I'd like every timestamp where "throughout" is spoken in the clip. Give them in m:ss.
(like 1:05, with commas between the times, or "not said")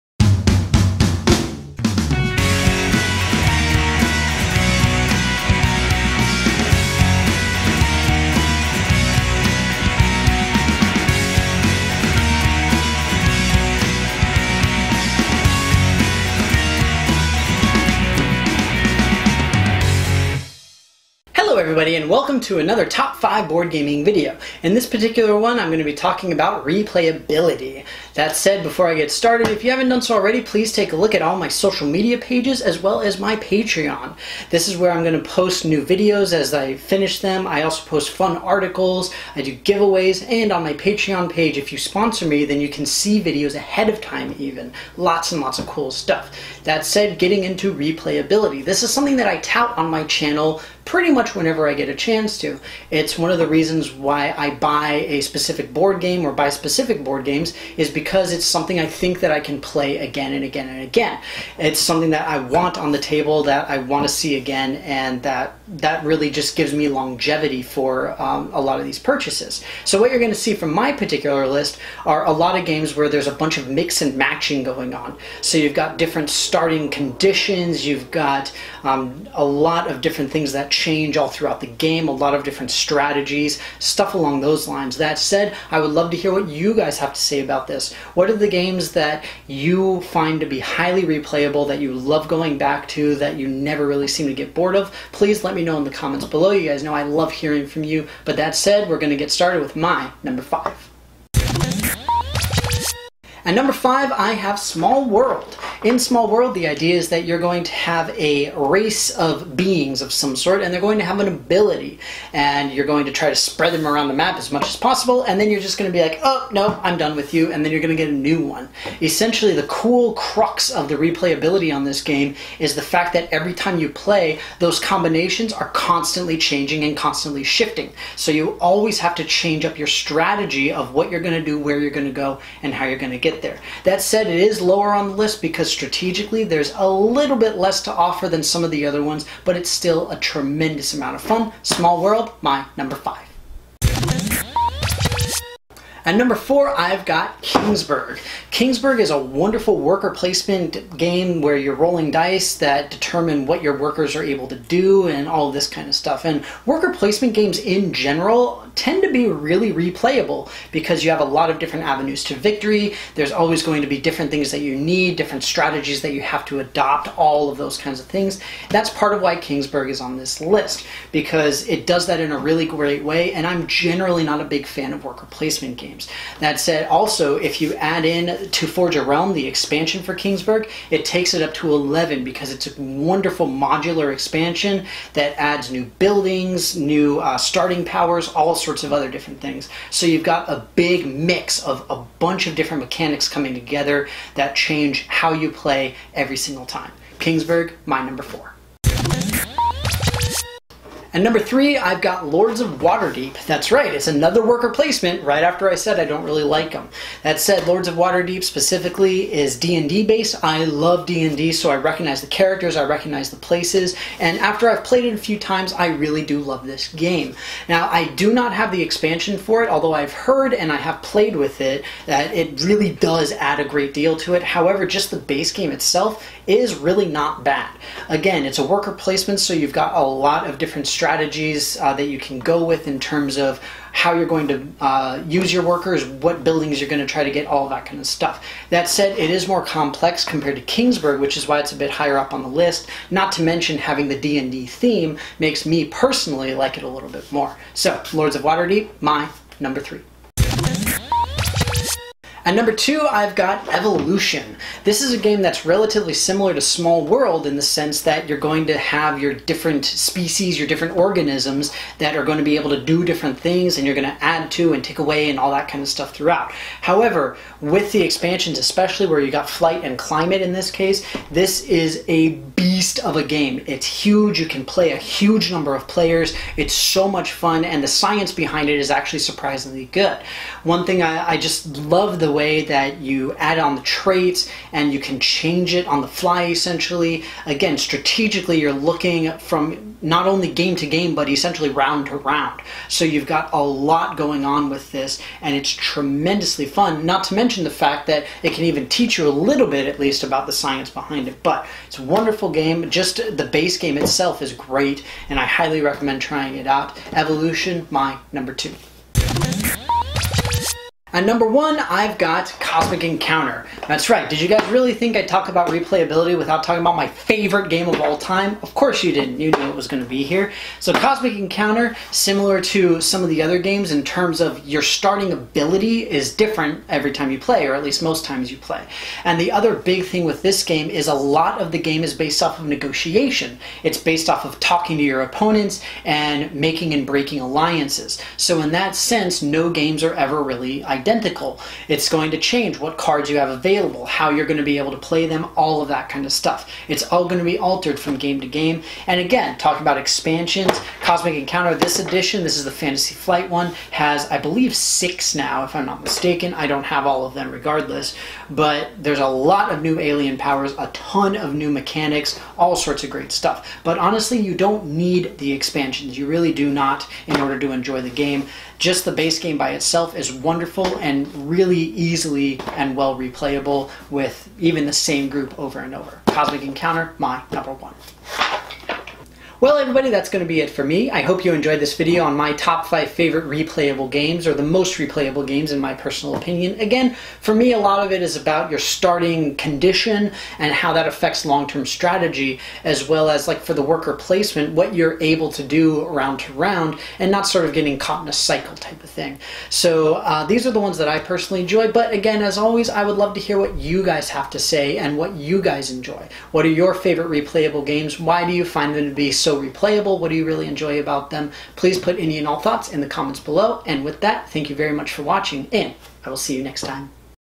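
1:21, 4:26.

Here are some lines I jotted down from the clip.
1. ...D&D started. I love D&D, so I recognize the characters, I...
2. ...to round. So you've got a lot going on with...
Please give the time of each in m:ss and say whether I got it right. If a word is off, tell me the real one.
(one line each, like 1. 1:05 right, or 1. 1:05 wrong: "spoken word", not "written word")
1. 3:29 wrong: "based", not "started"
2. 4:52 right.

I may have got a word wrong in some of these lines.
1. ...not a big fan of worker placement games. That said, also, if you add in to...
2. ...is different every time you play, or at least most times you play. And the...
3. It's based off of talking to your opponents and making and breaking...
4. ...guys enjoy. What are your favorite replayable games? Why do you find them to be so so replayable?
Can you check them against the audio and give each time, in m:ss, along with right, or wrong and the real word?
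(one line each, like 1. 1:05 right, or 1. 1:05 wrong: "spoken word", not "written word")
1. 2:54 right
2. 5:26 right
3. 5:33 right
4. 6:45 right.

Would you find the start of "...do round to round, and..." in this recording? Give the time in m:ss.
6:35.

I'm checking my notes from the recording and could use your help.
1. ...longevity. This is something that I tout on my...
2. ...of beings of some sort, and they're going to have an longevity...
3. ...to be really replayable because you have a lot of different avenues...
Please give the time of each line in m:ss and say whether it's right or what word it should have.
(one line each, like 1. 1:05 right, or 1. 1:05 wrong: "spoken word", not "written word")
1. 0:47 wrong: "replayability", not "longevity"
2. 1:49 wrong: "ability", not "longevity"
3. 2:39 right.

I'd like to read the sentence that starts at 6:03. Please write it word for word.
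But honestly, you don't need the expansions.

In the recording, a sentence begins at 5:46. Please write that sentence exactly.
It's all going to be altered from game to game.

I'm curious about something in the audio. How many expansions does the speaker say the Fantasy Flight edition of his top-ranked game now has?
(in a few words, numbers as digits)
6.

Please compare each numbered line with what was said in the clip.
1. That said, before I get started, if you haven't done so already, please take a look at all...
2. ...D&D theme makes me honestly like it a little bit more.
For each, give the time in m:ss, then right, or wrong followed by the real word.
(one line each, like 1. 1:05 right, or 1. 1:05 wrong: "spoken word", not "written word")
1. 0:28 right
2. 4:04 wrong: "personally", not "honestly".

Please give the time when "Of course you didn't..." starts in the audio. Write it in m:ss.
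5:18.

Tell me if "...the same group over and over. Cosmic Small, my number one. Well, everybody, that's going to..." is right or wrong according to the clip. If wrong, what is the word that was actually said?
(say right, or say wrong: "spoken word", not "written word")
wrong: "Encounter", not "Small".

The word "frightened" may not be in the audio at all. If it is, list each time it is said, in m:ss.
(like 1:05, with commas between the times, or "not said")
not said.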